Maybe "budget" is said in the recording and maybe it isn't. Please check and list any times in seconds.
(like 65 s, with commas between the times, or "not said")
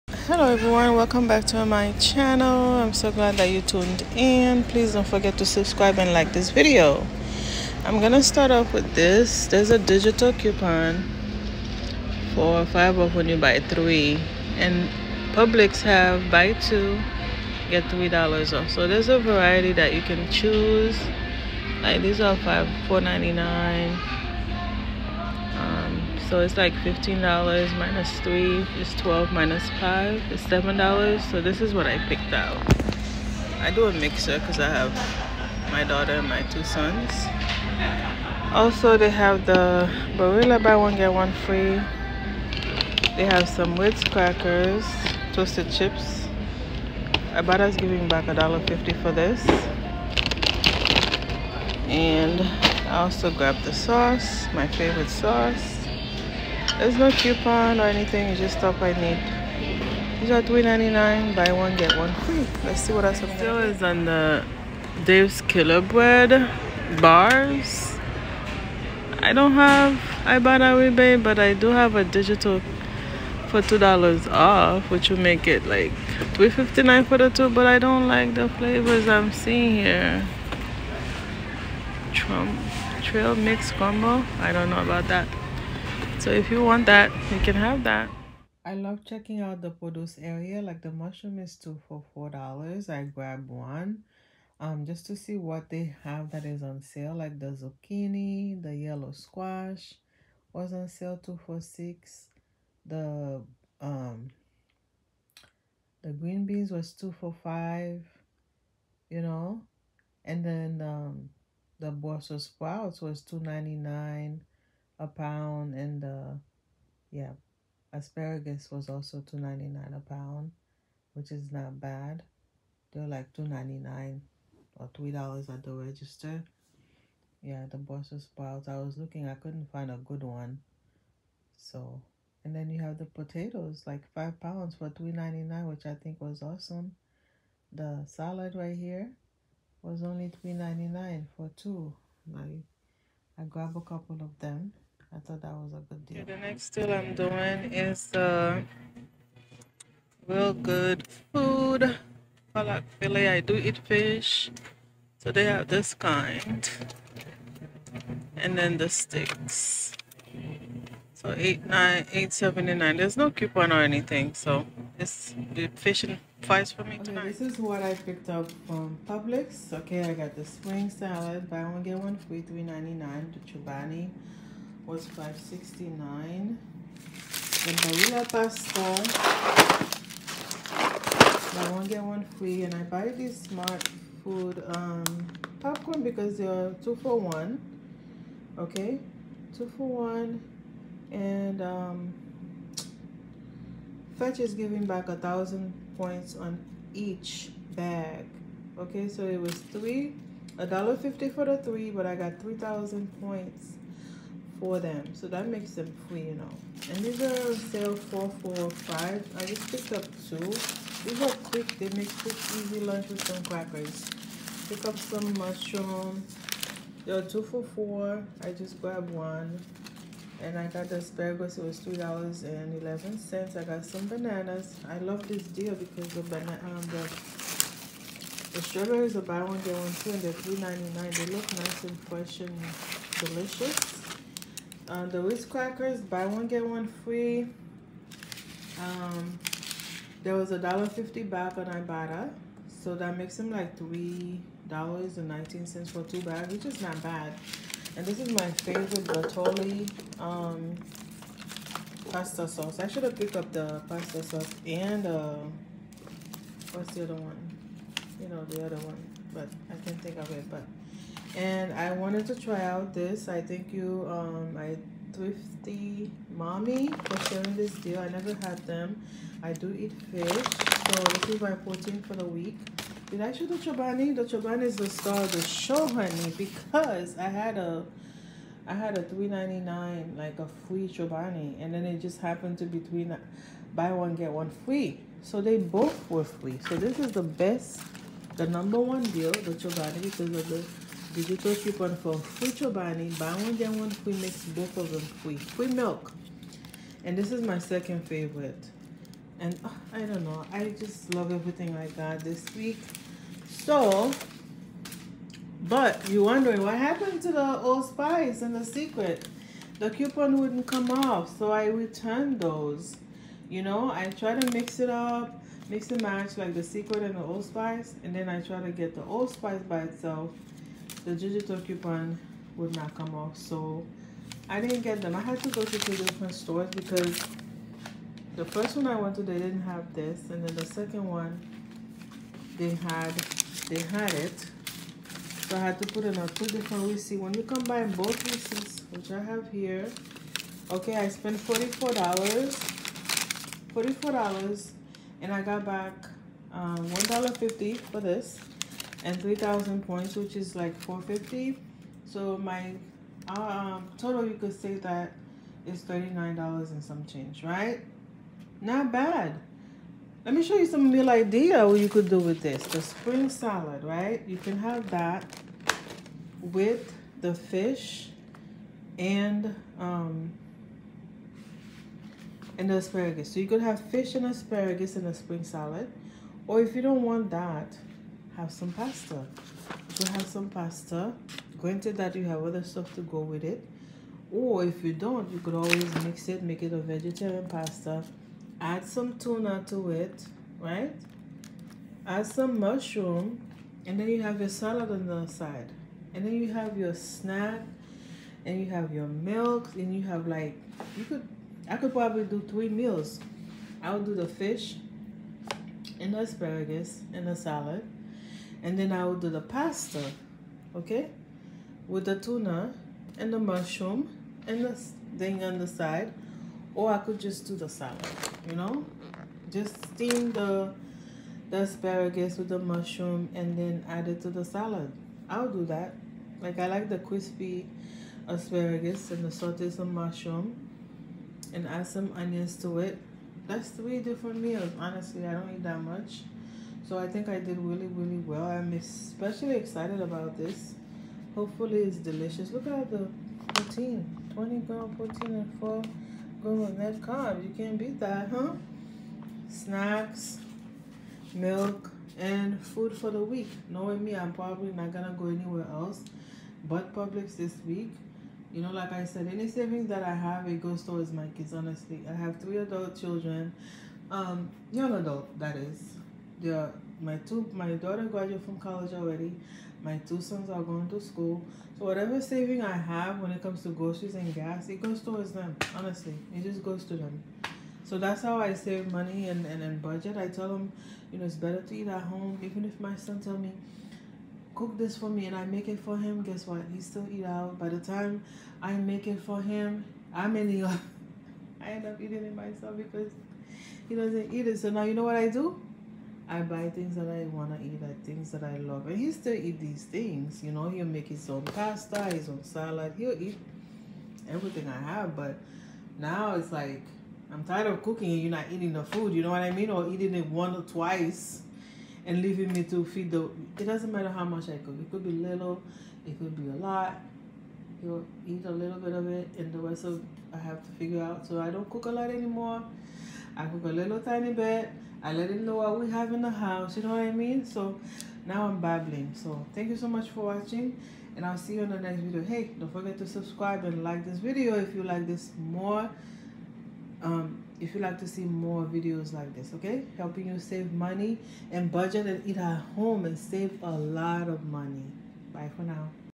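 479 s, 541 s.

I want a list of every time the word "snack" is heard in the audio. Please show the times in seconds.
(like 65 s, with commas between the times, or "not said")
396 s, 449 s.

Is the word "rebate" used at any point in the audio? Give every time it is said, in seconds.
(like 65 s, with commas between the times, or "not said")
70 s.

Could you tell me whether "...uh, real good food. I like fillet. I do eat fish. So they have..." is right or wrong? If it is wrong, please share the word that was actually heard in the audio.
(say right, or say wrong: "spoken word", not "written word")
right.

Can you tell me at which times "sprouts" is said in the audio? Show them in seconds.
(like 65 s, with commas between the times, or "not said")
112 s, 128 s.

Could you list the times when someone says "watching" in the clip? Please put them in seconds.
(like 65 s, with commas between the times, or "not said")
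530 s.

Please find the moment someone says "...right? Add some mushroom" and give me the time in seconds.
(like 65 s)
390 s.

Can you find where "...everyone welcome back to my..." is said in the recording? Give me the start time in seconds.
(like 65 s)
0 s.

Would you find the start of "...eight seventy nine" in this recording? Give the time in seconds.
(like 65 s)
162 s.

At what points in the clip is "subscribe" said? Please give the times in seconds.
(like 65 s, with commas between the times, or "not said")
5 s, 533 s.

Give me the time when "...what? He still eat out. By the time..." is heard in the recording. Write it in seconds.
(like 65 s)
486 s.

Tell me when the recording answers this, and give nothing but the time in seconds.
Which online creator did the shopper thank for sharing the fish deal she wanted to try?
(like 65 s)
264 s.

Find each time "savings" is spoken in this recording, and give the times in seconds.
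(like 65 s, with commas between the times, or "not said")
459 s, 472 s.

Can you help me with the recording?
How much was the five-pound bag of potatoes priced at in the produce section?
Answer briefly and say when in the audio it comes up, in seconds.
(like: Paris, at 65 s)
$3.99, at 134 s.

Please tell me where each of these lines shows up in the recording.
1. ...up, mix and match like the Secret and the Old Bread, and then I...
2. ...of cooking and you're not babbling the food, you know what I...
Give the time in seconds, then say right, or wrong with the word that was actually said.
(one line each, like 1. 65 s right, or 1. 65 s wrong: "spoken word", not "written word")
1. 314 s wrong: "Spice", not "Bread"
2. 507 s wrong: "eating", not "babbling".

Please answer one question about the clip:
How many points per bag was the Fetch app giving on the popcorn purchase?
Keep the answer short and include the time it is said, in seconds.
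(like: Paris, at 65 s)
1,000, at 195 s.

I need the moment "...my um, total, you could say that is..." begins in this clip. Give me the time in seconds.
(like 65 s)
352 s.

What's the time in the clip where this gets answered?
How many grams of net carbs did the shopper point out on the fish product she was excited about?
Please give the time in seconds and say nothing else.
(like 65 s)
445 s.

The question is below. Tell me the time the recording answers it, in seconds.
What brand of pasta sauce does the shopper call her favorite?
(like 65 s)
249 s.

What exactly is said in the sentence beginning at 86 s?
So if you want that, you can have that.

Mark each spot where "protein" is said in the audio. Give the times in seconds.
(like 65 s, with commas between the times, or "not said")
271 s, 444 s.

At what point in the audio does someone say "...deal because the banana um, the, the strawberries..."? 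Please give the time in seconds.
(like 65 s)
225 s.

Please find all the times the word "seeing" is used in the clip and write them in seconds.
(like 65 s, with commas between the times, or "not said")
79 s.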